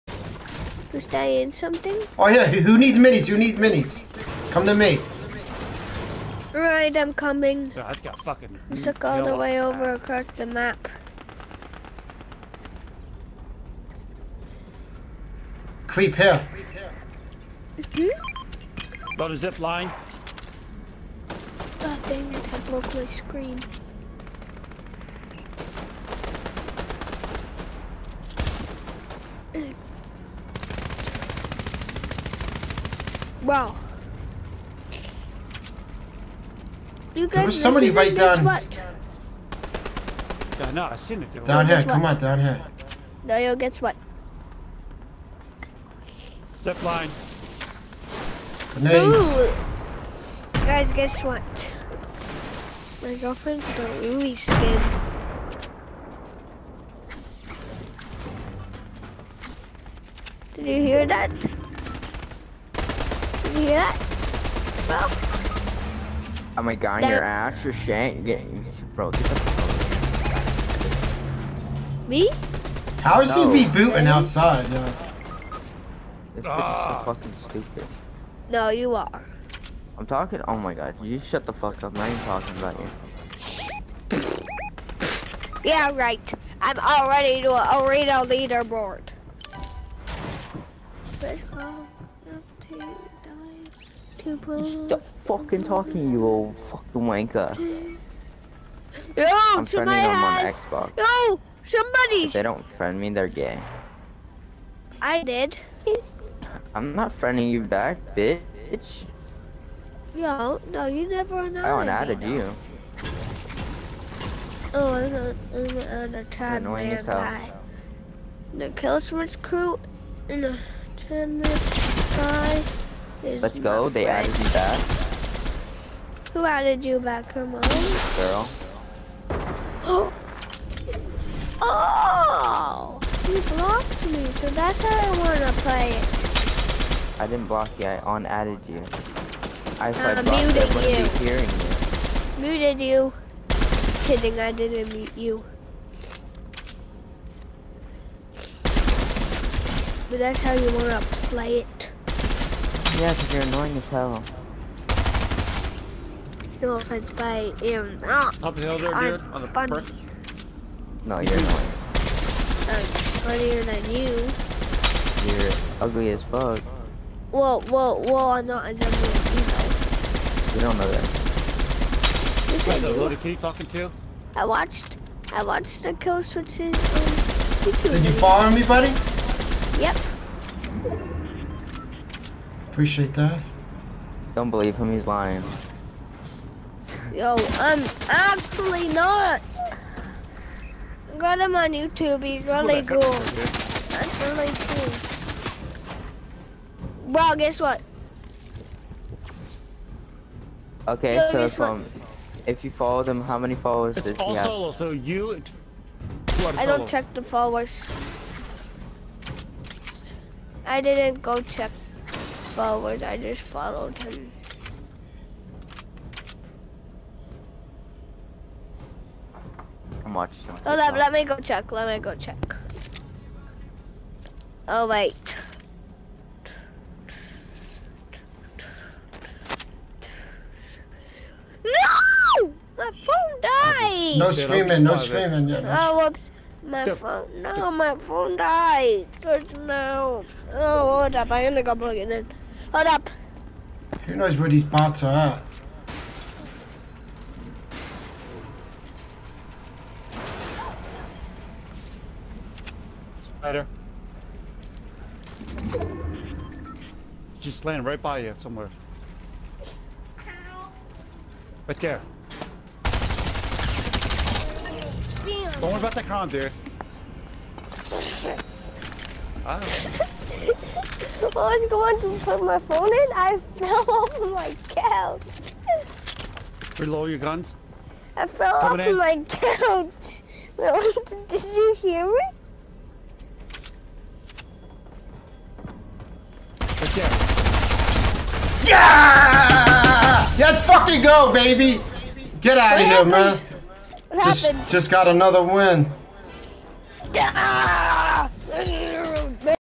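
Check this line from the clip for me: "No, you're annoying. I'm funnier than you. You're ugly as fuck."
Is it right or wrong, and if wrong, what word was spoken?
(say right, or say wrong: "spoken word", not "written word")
right.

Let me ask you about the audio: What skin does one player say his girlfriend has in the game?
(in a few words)
Louis skin.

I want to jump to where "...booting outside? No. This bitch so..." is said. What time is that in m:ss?
1:13.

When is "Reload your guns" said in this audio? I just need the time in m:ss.
4:36.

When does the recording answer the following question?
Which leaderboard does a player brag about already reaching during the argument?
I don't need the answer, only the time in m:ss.
1:27.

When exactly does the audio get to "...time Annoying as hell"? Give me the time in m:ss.
1:56.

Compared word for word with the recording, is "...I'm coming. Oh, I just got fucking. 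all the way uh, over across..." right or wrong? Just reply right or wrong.
right.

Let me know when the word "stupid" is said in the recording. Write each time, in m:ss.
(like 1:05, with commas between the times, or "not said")
1:17.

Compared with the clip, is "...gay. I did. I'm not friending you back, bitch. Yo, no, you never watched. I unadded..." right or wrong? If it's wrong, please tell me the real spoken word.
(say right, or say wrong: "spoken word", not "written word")
wrong: "unadded", not "watched".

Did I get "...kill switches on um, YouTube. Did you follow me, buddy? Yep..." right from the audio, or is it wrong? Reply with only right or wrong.
right.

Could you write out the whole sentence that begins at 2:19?
I, thought uh, I muted you.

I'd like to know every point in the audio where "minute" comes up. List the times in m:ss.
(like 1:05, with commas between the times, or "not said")
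2:01.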